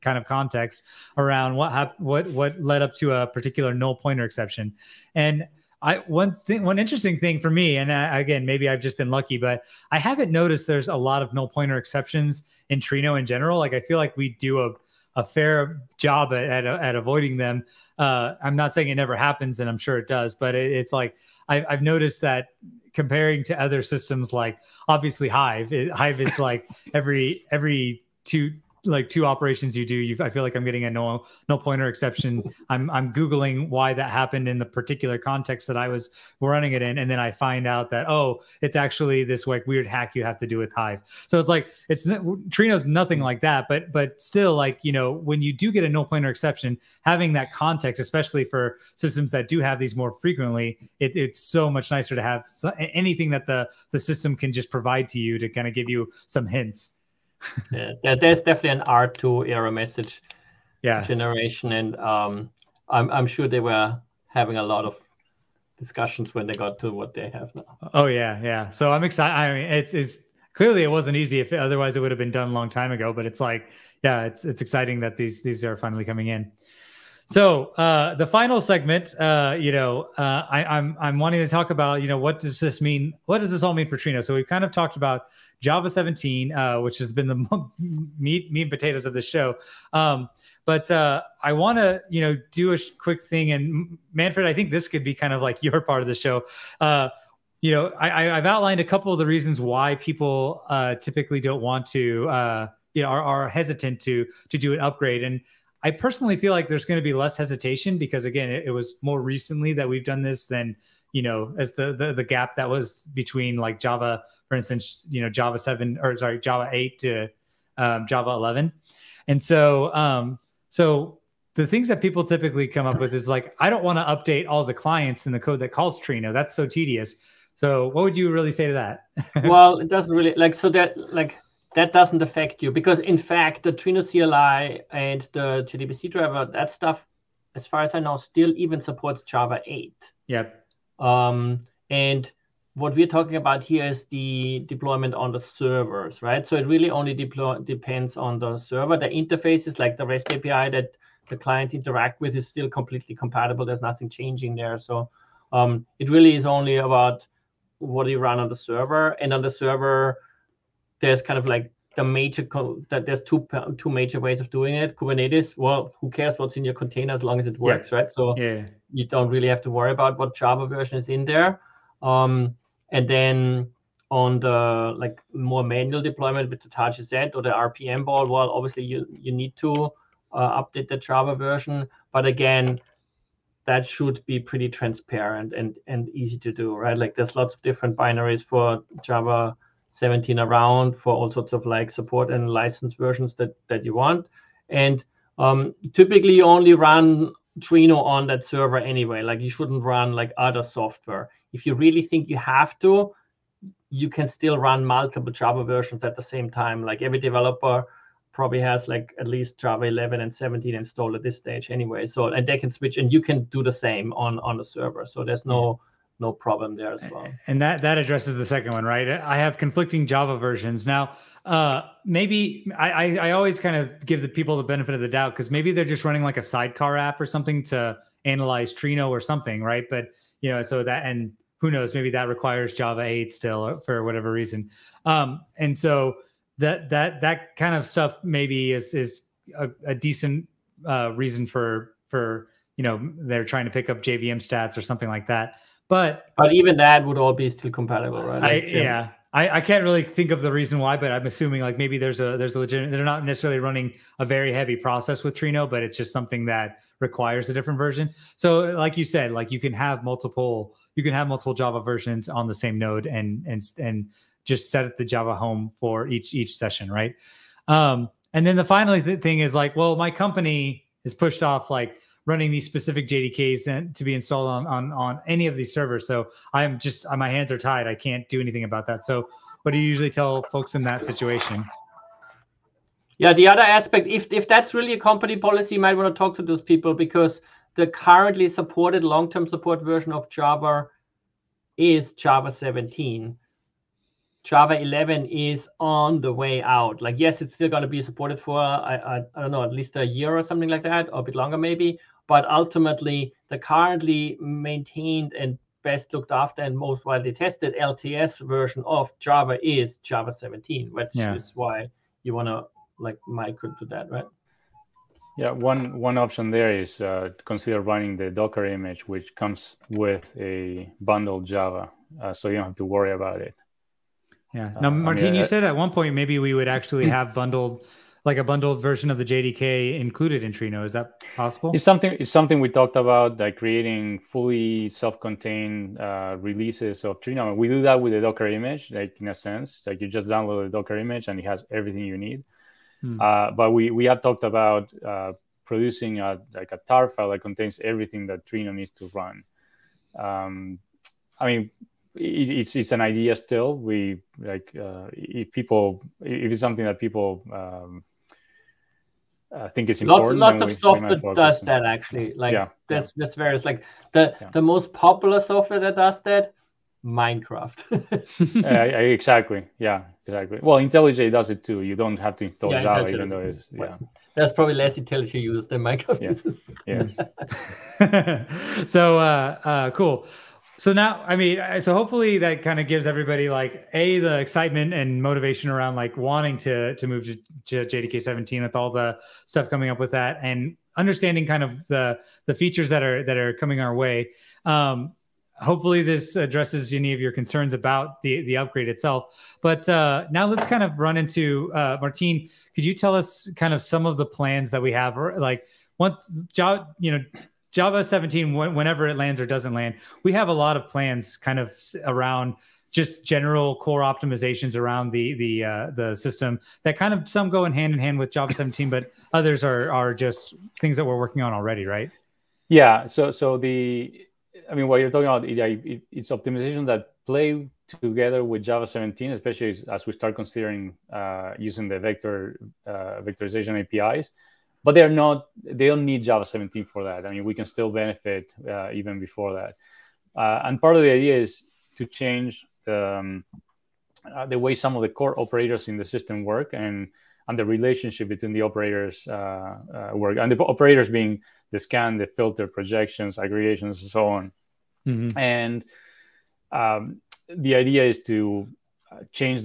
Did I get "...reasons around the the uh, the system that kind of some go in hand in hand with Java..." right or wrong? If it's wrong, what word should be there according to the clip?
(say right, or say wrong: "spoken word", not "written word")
wrong: "optimizations", not "reasons".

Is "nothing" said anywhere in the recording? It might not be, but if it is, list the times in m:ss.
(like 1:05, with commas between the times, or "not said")
0:42, 2:33.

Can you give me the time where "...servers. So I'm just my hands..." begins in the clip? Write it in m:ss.
4:35.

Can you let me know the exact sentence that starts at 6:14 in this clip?
That's probably less IntelliJ users than Minecraft yeah.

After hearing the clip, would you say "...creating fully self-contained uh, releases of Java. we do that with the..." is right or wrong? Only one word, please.
wrong.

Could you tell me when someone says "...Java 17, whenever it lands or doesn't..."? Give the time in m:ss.
6:47.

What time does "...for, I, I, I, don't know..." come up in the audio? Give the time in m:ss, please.
4:58.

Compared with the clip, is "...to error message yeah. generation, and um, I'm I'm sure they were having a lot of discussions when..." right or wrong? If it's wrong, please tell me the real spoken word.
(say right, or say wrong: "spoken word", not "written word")
right.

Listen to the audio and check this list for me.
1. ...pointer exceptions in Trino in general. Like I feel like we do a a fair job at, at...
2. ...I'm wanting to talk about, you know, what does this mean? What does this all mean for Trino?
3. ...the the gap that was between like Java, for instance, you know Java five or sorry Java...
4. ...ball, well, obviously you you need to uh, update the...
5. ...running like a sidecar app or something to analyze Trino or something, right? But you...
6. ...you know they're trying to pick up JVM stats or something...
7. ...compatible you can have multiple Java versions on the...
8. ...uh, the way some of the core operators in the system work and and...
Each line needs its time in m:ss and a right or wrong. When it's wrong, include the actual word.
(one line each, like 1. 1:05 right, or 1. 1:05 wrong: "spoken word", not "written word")
1. 0:11 right
2. 1:21 right
3. 1:51 wrong: "seven", not "five"
4. 2:58 right
5. 3:46 right
6. 4:02 right
7. 4:20 wrong: "multiple", not "compatible"
8. 7:24 right.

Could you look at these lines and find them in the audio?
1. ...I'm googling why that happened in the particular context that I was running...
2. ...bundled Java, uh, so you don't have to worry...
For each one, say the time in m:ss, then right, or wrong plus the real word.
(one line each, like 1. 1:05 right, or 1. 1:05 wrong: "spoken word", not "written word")
1. 0:32 right
2. 5:21 right.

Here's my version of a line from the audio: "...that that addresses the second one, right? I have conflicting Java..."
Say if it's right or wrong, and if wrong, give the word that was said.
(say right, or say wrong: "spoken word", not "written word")
right.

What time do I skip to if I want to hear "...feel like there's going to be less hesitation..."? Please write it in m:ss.
1:46.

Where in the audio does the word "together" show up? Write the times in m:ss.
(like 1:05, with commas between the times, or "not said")
7:07.